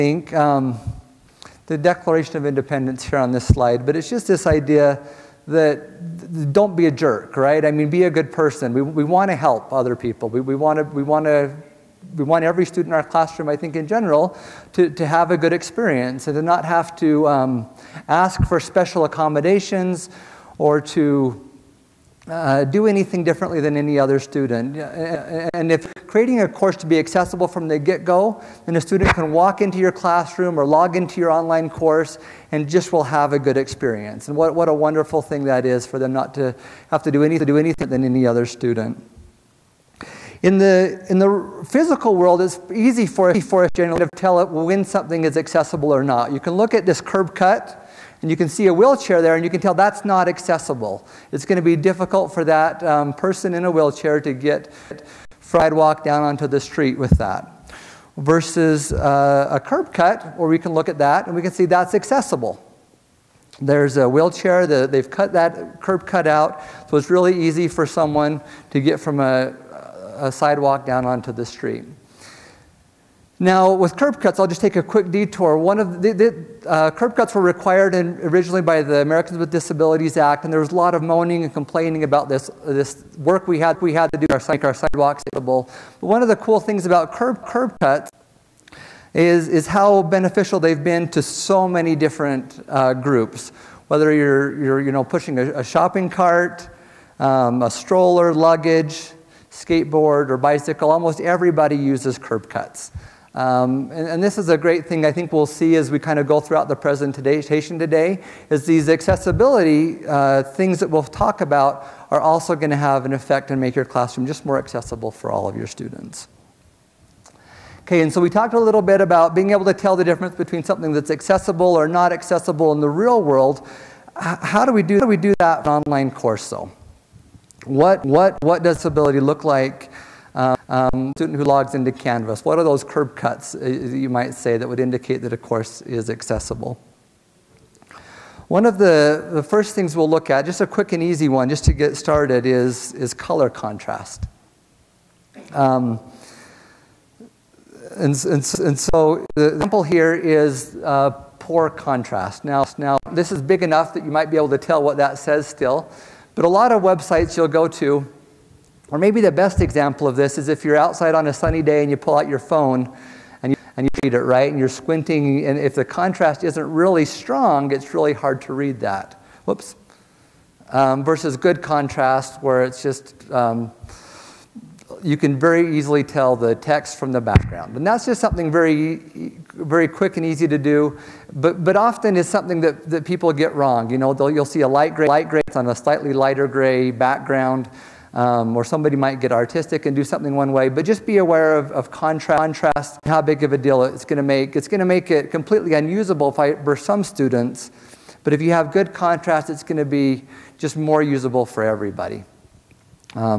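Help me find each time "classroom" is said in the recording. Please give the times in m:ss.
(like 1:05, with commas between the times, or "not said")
0:13, 0:29, 1:53.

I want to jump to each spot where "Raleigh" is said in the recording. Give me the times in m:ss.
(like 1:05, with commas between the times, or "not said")
not said.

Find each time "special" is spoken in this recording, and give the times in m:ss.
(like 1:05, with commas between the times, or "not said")
0:18.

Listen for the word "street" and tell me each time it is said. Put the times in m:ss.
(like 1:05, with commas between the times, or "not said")
0:56, 1:11.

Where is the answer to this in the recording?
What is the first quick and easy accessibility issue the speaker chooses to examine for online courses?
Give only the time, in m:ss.
2:23.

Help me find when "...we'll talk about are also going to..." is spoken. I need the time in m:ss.
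1:50.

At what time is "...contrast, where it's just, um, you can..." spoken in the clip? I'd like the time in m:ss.
2:51.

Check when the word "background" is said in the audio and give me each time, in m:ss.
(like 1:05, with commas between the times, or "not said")
2:57, 3:06.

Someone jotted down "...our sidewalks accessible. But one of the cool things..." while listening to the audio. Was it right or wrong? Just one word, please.
right.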